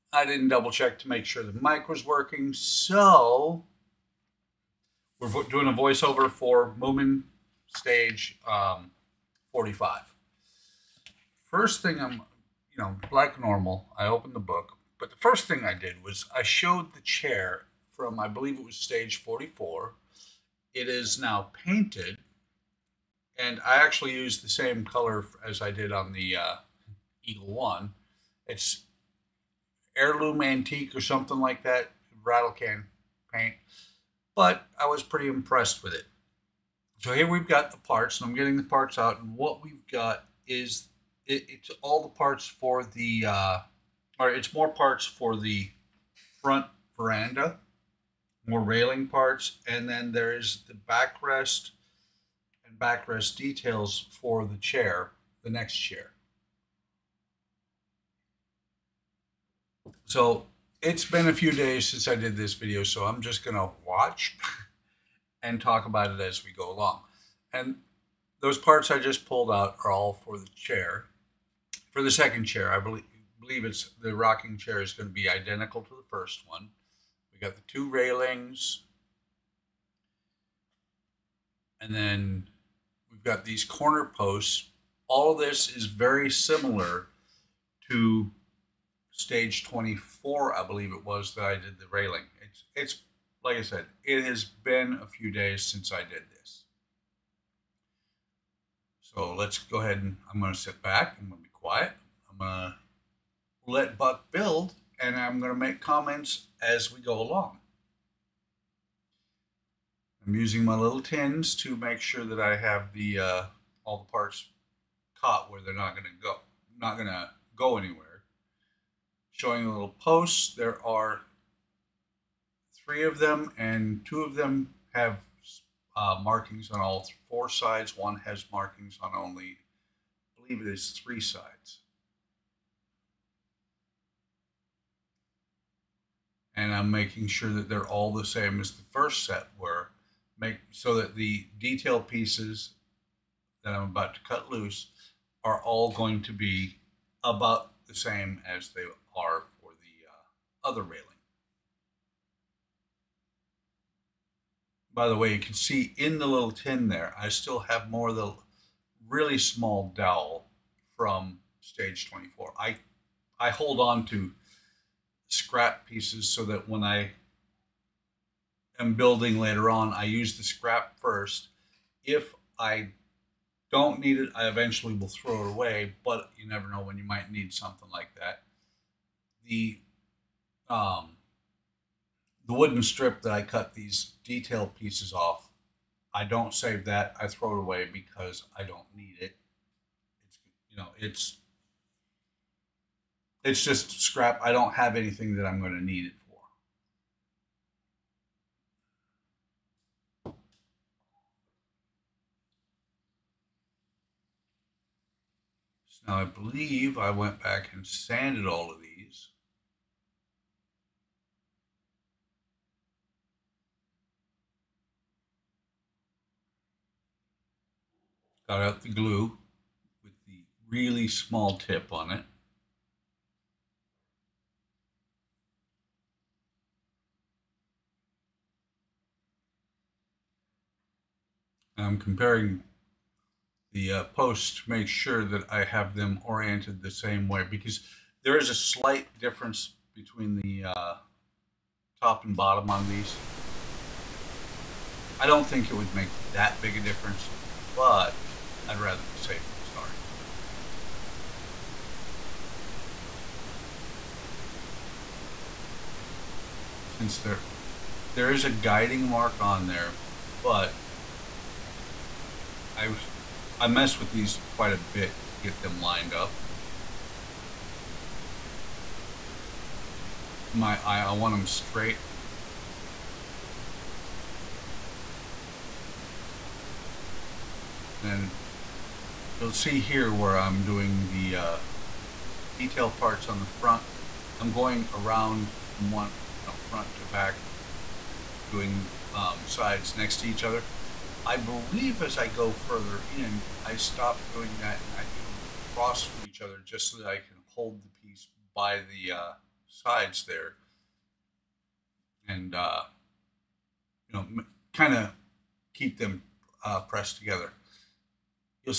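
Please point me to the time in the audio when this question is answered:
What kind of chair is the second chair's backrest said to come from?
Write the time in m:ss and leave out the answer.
1:14.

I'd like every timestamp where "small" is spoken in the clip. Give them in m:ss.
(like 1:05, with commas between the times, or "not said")
2:39, 3:41.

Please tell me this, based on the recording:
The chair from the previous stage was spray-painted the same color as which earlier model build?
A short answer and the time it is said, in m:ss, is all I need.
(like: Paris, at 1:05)
Eagle One, at 0:27.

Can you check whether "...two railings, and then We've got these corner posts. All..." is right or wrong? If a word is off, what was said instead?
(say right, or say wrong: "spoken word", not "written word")
right.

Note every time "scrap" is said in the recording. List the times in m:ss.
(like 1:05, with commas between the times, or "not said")
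2:45, 2:50, 3:14.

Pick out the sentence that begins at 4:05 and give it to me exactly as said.
I don't think it would make that big a difference, but I'd rather be safe than sorry.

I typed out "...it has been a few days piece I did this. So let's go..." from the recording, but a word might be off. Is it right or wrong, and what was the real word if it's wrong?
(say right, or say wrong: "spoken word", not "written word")
wrong: "since", not "piece".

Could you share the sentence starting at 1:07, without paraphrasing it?
And those parts I just pulled out are all for the chair.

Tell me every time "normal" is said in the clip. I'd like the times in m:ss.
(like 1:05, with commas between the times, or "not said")
0:13.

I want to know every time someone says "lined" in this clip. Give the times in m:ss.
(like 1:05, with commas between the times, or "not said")
4:25.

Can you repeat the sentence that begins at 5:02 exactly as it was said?
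And, uh, you know, kind of keep them uh, pressed together.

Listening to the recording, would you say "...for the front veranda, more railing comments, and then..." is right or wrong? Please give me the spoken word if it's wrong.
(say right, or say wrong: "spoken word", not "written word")
wrong: "parts", not "comments".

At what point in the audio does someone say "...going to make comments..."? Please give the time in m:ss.
1:45.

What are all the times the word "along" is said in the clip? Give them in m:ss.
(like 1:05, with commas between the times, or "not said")
1:06, 1:47.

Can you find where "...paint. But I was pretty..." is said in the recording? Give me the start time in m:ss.
0:33.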